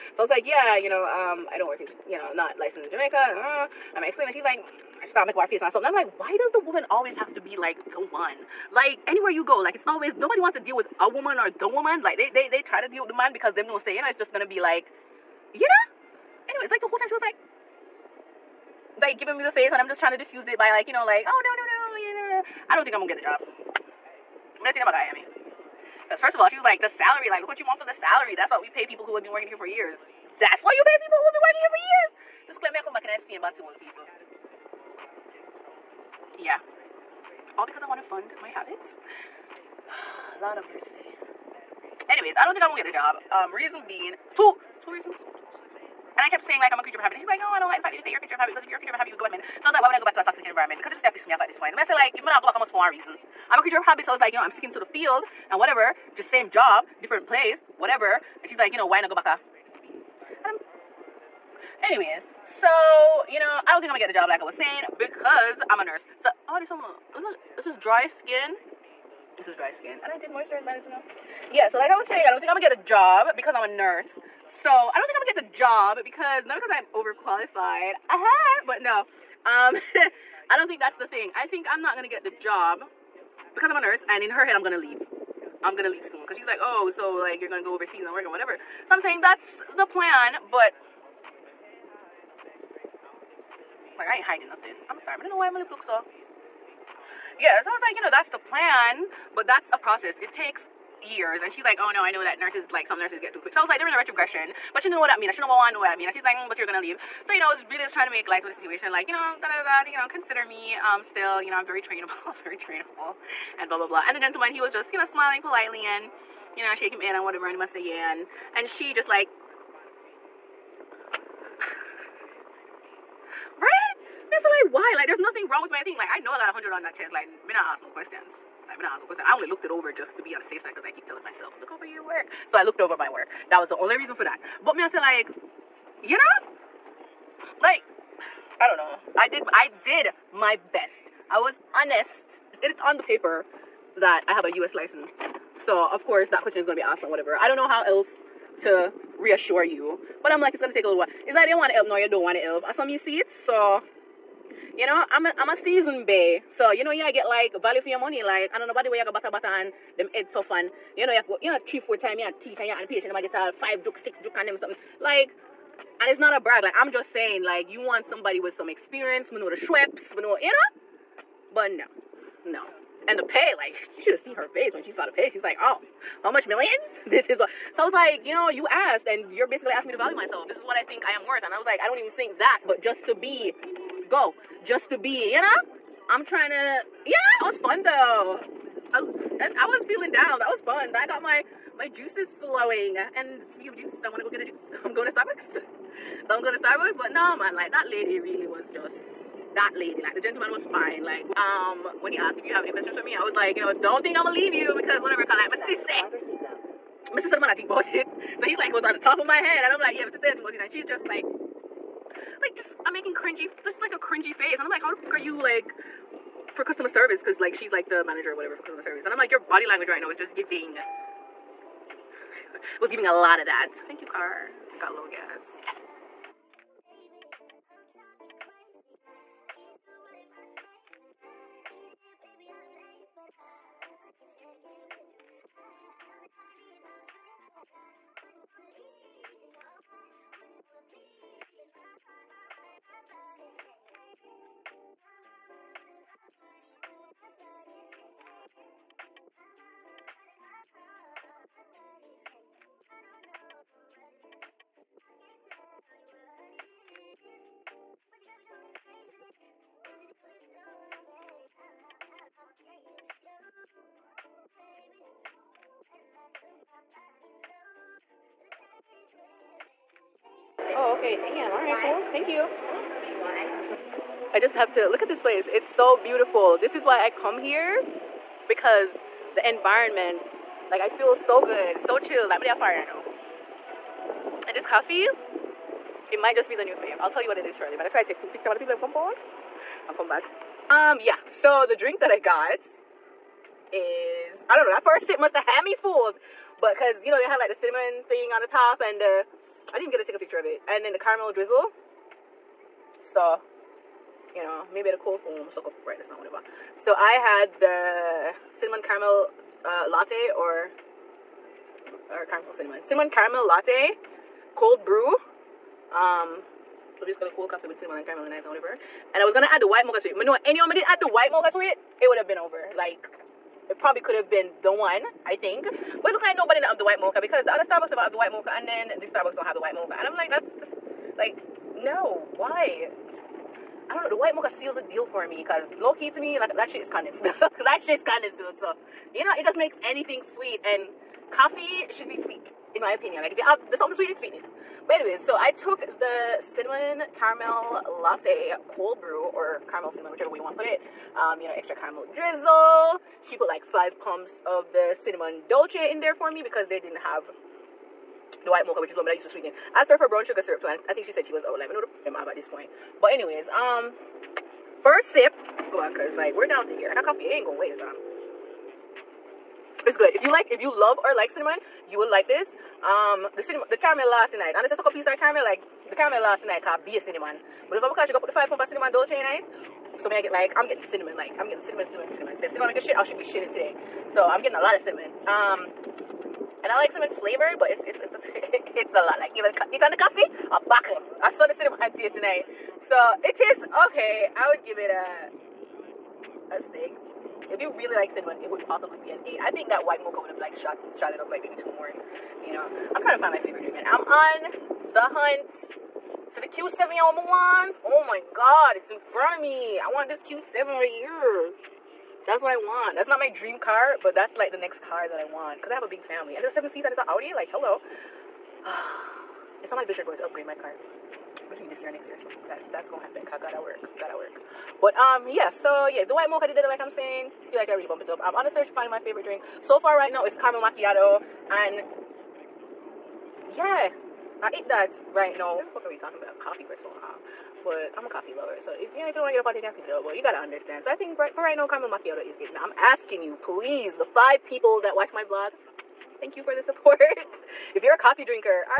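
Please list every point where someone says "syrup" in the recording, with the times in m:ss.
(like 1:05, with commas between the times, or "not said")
6:00.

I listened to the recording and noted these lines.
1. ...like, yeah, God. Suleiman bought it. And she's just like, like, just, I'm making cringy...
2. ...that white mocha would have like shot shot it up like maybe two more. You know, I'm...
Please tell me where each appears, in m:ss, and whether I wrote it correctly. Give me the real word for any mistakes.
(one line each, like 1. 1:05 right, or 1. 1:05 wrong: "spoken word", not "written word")
1. 3:29 wrong: "Mrs", not "God"
2. 6:39 right.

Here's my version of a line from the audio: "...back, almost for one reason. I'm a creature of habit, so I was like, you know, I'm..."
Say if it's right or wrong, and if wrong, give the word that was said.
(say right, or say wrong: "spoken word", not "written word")
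right.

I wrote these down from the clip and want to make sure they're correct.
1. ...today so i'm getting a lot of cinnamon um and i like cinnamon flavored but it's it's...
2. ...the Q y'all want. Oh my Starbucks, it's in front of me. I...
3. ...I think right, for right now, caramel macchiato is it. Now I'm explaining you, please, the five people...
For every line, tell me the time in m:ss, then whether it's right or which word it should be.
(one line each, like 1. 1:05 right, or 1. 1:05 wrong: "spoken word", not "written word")
1. 6:23 right
2. 6:46 wrong: "God", not "Starbucks"
3. 7:20 wrong: "asking", not "explaining".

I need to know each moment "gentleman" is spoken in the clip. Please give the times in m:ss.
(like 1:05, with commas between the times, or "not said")
1:54, 3:20.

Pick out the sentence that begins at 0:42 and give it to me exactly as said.
Anyways, I don't think I'm gonna get a job.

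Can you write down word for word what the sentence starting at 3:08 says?
I, and I was feeling down.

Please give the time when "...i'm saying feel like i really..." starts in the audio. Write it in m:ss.
7:06.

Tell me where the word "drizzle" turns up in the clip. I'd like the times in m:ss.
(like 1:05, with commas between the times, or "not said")
5:01, 5:52.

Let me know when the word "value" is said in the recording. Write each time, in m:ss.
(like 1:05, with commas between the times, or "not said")
2:37, 2:59.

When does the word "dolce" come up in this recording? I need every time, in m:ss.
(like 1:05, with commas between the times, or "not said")
5:55, 6:18.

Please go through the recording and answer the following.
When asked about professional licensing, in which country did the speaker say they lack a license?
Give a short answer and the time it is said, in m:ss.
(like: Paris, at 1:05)
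Jamaica, at 0:02.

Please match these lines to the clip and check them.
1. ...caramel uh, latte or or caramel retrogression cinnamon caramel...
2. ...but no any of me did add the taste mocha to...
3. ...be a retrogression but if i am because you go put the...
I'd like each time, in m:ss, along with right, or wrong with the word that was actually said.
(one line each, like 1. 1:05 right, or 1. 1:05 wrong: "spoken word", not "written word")
1. 5:08 wrong: "cinnamon", not "retrogression"
2. 5:20 wrong: "white", not "taste"
3. 6:16 wrong: "cinnamon", not "retrogression".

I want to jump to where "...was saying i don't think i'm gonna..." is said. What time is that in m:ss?
1:11.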